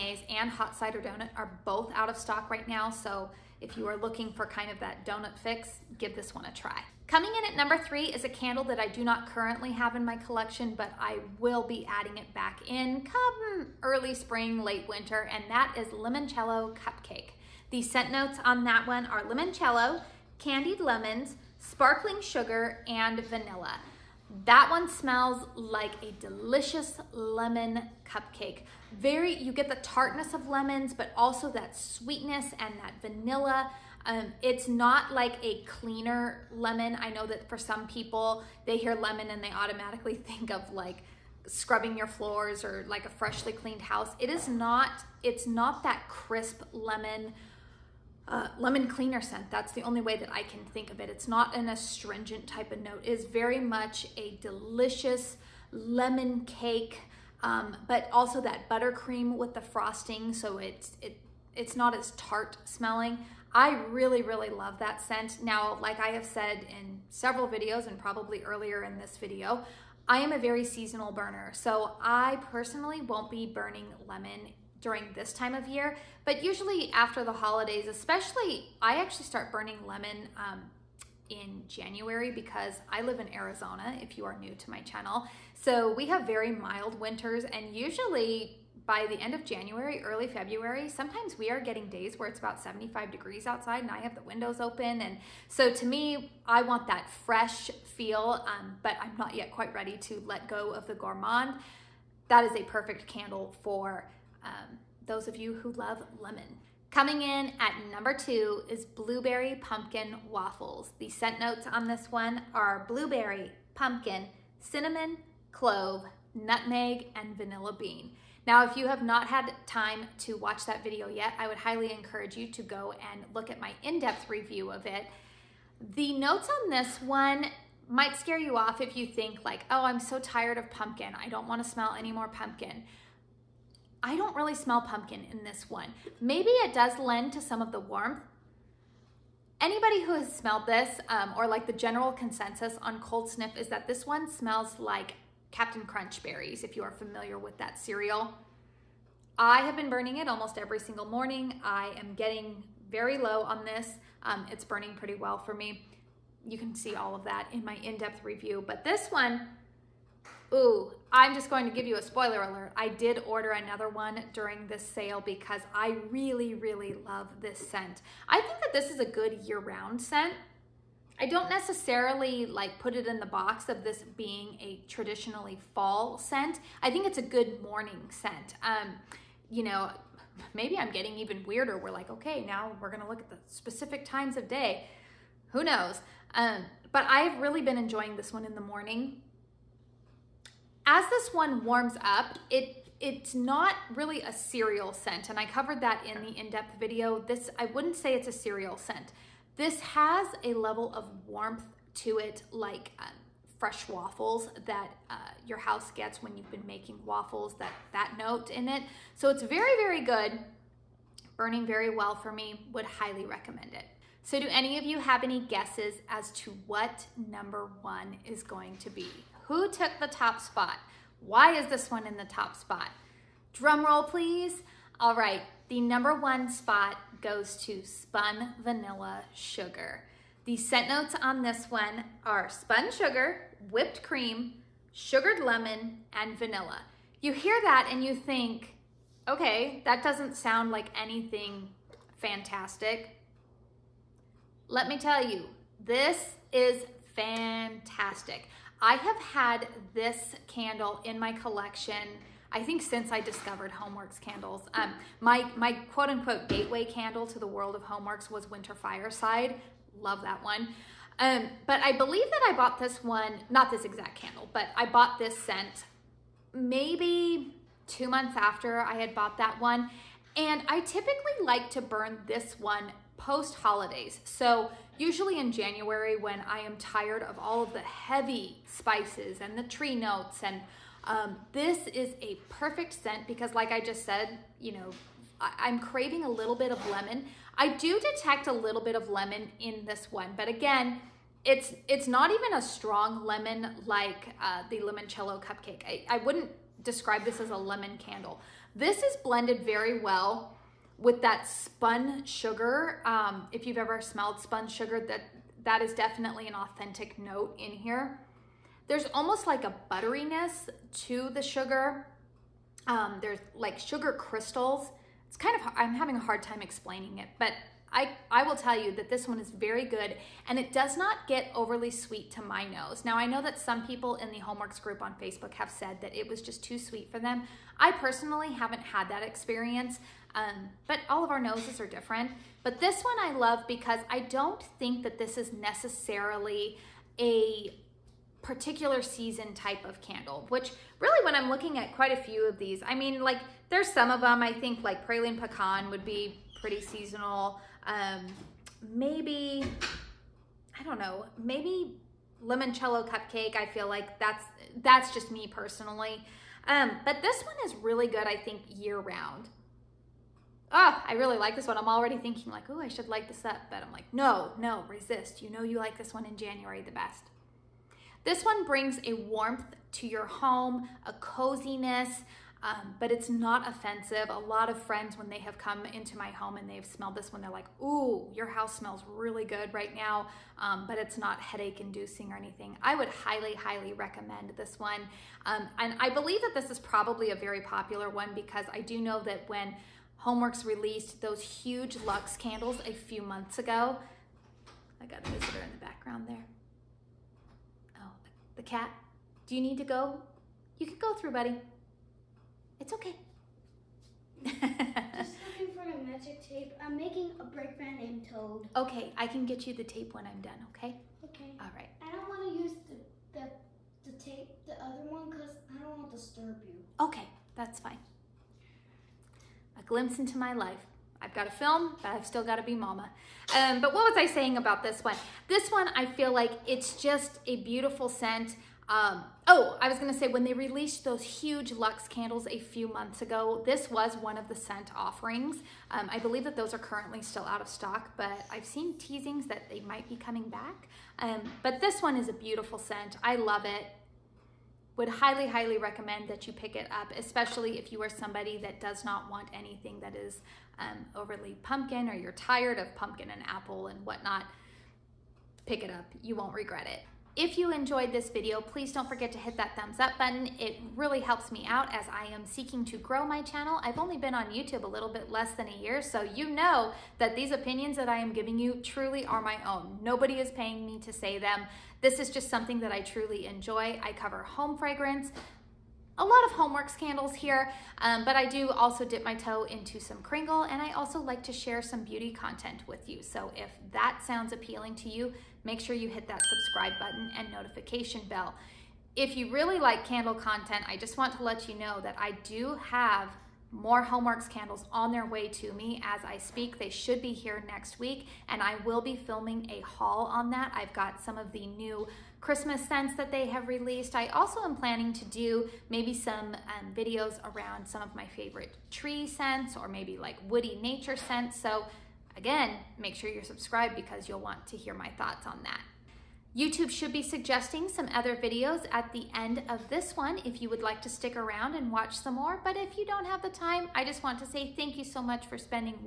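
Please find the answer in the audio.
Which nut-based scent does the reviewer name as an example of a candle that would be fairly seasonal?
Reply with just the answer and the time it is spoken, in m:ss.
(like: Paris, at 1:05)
Praline pecan, at 5:45.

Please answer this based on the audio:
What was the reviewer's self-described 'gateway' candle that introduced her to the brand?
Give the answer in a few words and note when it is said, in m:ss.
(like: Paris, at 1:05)
Winter Fireside, at 4:18.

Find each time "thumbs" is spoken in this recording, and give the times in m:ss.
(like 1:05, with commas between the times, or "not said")
7:39.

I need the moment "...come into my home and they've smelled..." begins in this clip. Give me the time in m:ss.
6:15.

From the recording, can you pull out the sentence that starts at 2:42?
I did order another one during this sale because I really, really love this scent.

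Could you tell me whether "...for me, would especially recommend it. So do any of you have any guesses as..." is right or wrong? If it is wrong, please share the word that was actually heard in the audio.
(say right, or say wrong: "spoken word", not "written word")
wrong: "highly", not "especially".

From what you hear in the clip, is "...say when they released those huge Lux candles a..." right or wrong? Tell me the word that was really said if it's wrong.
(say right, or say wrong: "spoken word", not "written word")
right.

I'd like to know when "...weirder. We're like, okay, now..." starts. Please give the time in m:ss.
3:01.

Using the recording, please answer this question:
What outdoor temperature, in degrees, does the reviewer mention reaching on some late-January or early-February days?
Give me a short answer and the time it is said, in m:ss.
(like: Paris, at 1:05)
75, at 1:32.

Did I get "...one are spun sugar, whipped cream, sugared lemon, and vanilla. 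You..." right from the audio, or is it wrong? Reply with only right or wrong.
right.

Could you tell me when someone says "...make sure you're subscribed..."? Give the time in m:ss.
8:32.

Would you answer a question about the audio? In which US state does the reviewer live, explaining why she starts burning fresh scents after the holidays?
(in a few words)
Arizona.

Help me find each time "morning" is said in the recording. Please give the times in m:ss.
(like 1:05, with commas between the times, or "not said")
2:31, 2:57, 3:08.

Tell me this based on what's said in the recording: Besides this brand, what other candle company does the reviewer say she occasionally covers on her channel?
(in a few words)
Kringle.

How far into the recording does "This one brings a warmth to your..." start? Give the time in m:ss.
6:08.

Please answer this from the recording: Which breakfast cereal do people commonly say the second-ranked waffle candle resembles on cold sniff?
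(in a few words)
Captain Crunch berries.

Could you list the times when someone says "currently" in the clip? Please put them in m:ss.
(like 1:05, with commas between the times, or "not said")
0:09, 7:16.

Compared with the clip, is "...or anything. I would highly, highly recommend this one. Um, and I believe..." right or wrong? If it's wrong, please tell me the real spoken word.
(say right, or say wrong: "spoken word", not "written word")
right.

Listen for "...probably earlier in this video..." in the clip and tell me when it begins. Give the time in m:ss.
1:07.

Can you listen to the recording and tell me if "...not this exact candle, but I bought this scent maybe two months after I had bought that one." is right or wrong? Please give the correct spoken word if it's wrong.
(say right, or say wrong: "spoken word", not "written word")
right.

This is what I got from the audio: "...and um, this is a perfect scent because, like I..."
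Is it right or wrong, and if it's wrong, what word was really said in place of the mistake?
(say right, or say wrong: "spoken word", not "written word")
right.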